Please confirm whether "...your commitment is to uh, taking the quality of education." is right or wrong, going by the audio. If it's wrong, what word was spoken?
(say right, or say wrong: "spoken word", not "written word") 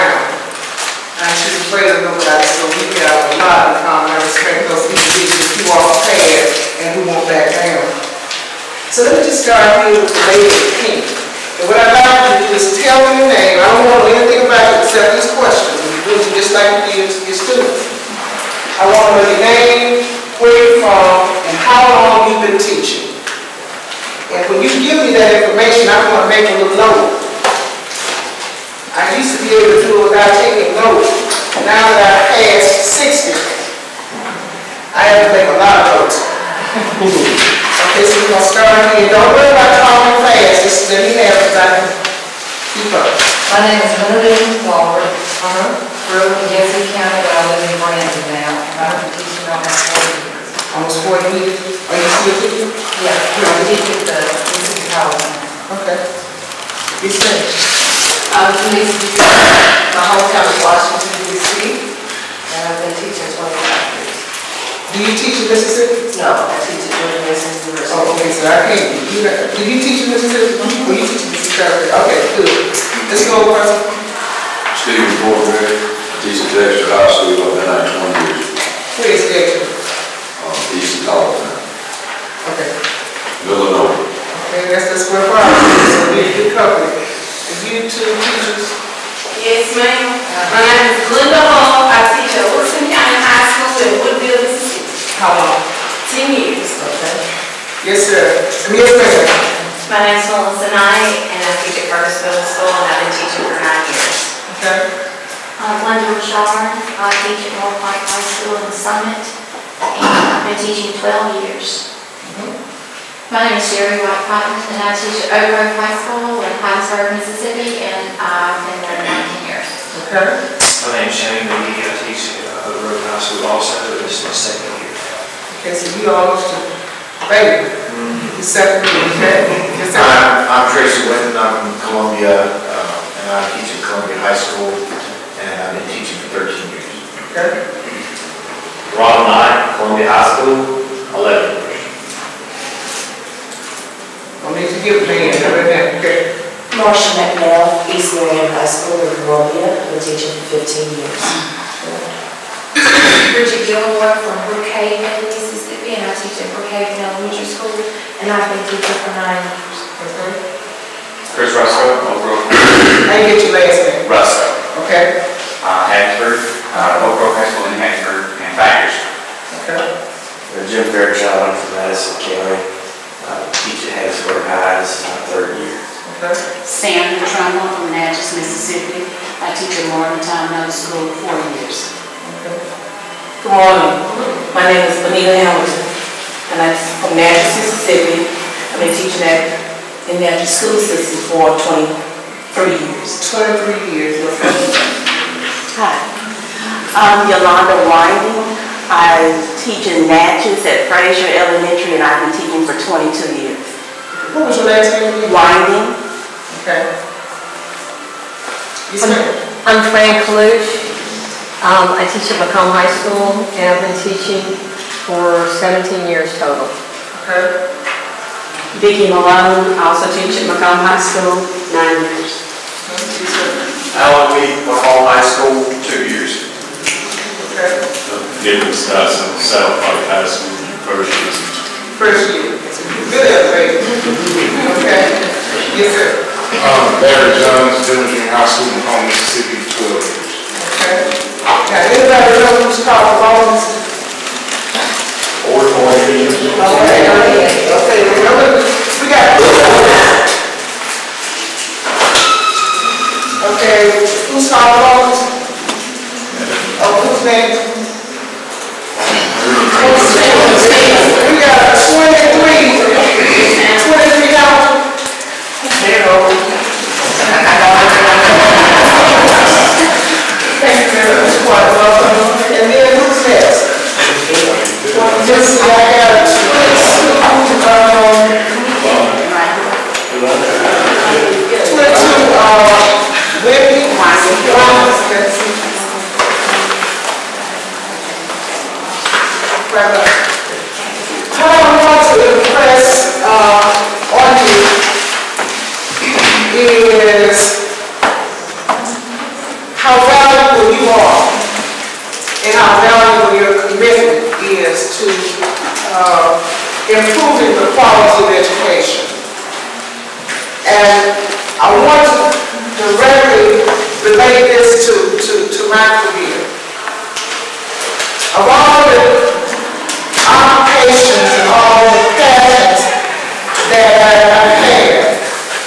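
wrong: "improving", not "taking".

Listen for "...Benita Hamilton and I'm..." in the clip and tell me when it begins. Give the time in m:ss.
3:05.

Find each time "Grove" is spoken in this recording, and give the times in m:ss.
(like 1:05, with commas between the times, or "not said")
1:55, 2:02, 2:42, 2:47.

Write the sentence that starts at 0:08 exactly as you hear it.
So let me just start here with the lady of and what I'd like you to do is tell me your name.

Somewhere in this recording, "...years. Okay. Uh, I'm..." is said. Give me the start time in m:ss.
1:43.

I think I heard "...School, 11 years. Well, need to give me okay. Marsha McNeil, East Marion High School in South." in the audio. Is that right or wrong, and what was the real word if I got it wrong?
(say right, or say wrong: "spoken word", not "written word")
wrong: "Columbia", not "South".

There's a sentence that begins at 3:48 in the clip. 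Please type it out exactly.
Different starts in South Pike High School, first year.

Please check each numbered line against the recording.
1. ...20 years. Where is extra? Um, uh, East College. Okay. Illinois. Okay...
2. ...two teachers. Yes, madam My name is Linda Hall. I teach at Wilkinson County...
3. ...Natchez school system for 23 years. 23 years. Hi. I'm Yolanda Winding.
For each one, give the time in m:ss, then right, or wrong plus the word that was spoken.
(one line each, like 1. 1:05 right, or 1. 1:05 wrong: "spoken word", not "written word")
1. 1:17 right
2. 1:27 right
3. 3:10 right.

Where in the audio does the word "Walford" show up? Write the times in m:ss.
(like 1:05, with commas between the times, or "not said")
0:44.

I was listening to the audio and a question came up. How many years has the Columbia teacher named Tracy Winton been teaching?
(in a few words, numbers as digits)
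13.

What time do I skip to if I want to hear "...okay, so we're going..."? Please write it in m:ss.
0:37.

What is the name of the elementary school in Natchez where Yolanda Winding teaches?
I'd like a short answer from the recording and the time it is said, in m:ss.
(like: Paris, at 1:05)
Fraser Elementary, at 3:20.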